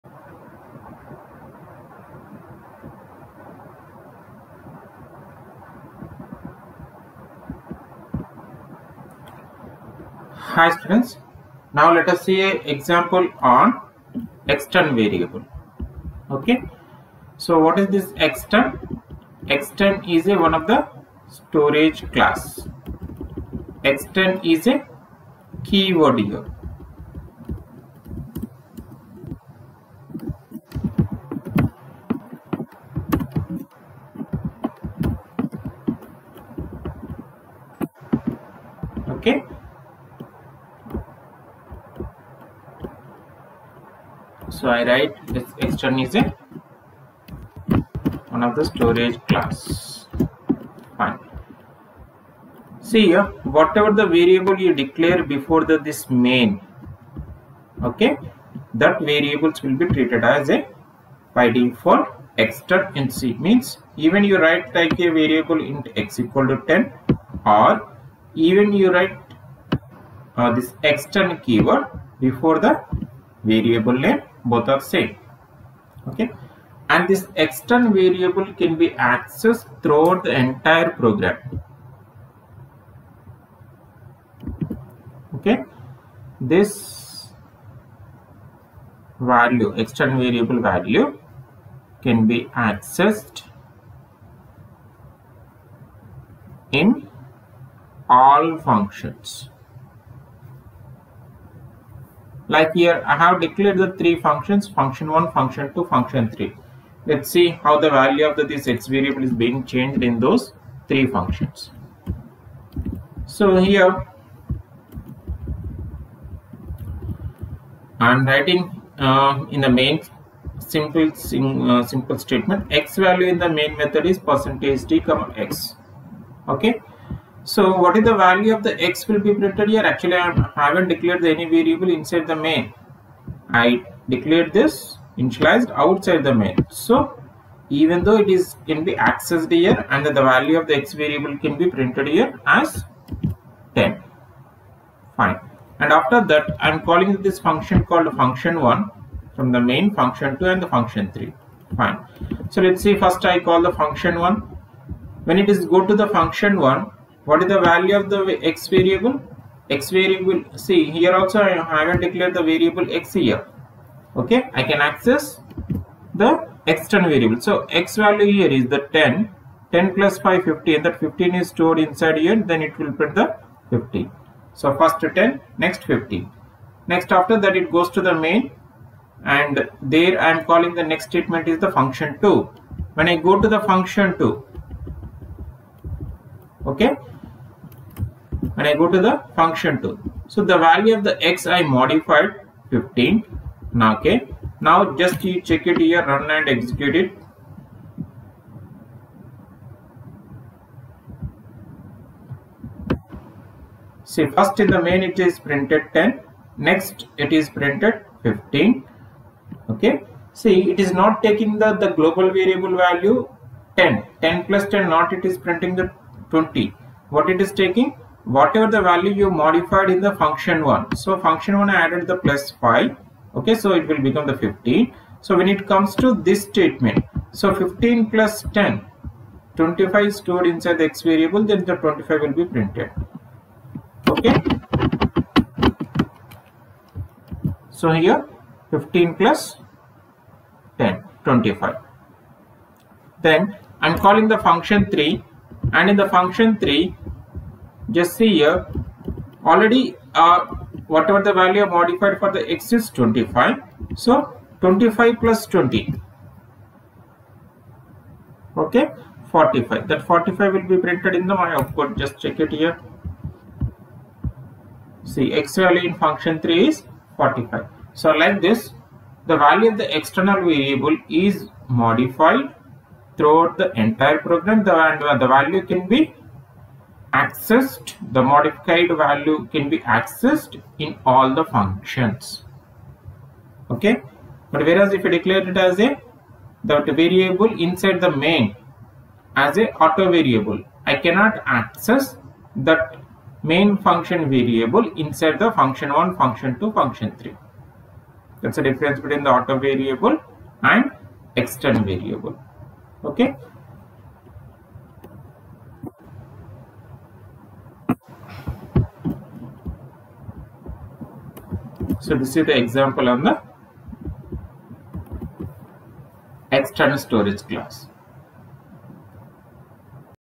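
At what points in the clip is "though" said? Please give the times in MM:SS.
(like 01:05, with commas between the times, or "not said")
02:18.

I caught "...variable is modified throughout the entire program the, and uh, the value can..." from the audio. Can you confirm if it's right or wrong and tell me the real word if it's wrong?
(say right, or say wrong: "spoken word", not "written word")
right.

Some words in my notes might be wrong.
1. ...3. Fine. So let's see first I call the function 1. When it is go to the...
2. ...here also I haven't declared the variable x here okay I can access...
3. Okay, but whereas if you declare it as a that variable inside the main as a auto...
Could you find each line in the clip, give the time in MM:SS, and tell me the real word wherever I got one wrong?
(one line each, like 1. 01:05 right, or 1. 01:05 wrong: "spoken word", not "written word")
1. 02:31 right
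2. 02:40 right
3. 04:43 right.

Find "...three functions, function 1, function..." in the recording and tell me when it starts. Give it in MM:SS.
01:43.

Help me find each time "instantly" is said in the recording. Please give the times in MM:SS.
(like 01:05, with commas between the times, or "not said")
not said.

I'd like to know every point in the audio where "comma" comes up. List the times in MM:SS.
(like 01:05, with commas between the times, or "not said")
02:04.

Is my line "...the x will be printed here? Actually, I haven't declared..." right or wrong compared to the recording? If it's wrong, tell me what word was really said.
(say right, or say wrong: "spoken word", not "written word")
right.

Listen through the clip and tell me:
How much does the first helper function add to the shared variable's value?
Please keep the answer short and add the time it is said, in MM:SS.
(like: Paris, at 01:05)
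5, at 02:49.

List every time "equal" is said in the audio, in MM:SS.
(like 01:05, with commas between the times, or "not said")
01:06.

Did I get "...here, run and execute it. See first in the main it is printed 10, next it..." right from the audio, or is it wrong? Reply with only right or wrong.
right.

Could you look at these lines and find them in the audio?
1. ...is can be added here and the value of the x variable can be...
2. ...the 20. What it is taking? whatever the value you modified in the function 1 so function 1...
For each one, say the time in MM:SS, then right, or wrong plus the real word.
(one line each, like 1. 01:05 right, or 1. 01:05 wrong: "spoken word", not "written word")
1. 02:18 wrong: "accessed", not "added"
2. 03:35 right.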